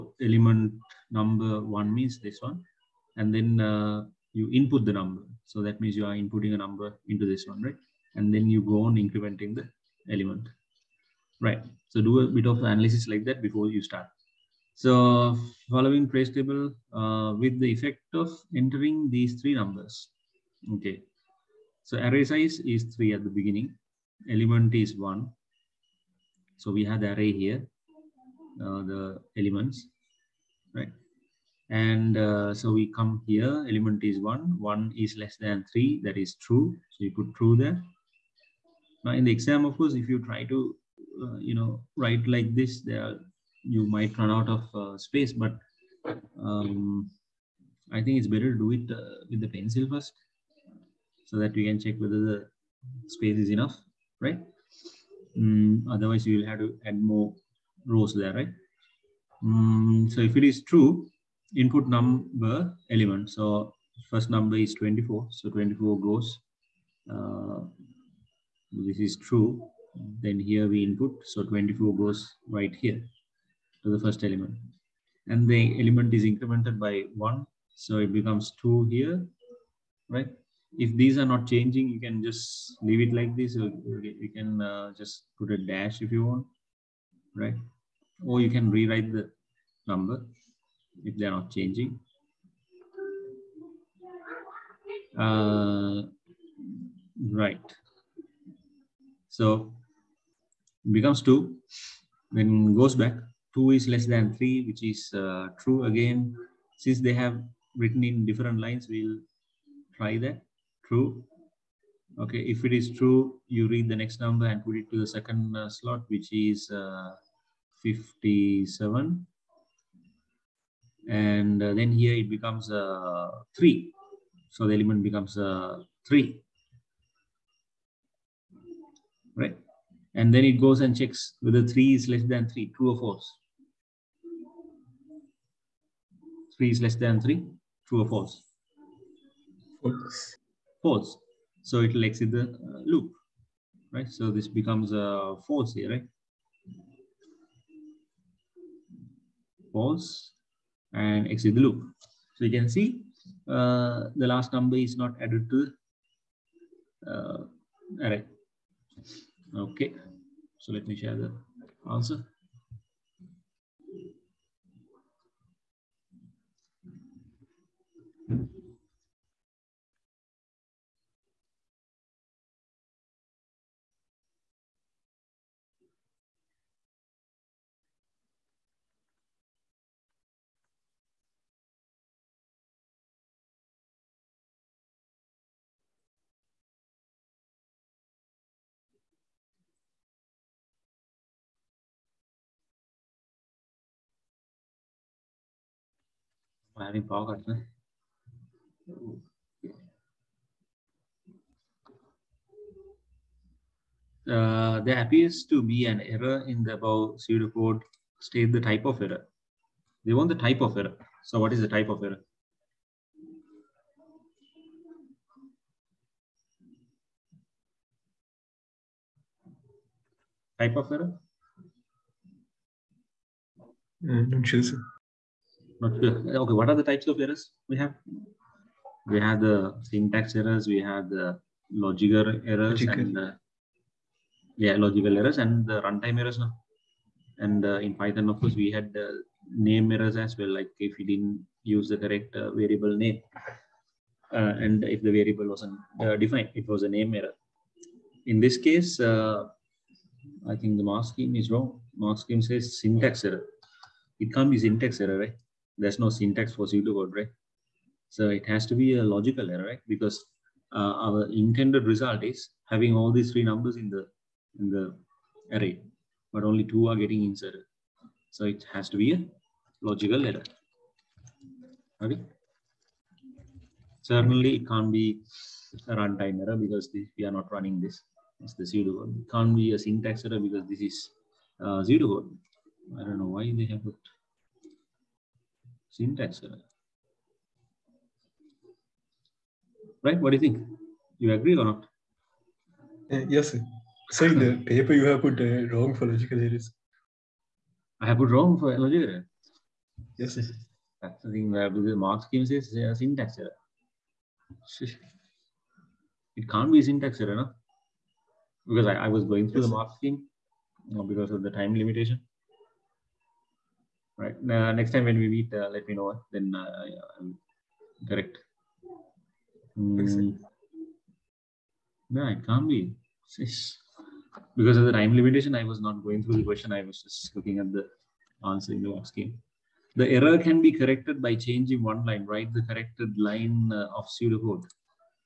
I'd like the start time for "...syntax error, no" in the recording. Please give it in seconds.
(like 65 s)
306 s.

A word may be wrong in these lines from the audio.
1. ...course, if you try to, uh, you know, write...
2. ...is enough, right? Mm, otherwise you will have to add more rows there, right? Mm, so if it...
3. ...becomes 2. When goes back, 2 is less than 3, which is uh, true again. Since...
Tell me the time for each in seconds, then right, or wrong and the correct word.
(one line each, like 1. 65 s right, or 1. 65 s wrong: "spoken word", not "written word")
1. 39 s right
2. 53 s right
3. 100 s right.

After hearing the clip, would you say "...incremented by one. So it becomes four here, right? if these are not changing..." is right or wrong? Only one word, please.
wrong.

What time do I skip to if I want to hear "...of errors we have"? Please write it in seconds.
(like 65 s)
227 s.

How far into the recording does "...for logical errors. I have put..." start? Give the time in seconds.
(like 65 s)
295 s.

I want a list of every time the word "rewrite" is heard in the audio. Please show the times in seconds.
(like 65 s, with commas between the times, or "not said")
88 s.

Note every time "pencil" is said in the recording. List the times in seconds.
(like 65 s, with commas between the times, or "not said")
49 s.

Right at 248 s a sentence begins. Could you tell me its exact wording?
In this case, I think the mark scheme is wrong.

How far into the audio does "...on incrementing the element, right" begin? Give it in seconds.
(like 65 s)
8 s.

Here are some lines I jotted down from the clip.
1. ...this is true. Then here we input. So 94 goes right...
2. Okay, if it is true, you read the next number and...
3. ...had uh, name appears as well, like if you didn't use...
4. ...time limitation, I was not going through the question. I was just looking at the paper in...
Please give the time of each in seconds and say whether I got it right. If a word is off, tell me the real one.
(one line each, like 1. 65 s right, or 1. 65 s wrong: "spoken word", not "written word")
1. 68 s wrong: "24", not "94"
2. 112 s right
3. 238 s wrong: "errors", not "appears"
4. 324 s wrong: "answer", not "paper".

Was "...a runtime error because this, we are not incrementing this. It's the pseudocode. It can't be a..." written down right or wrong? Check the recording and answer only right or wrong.
wrong.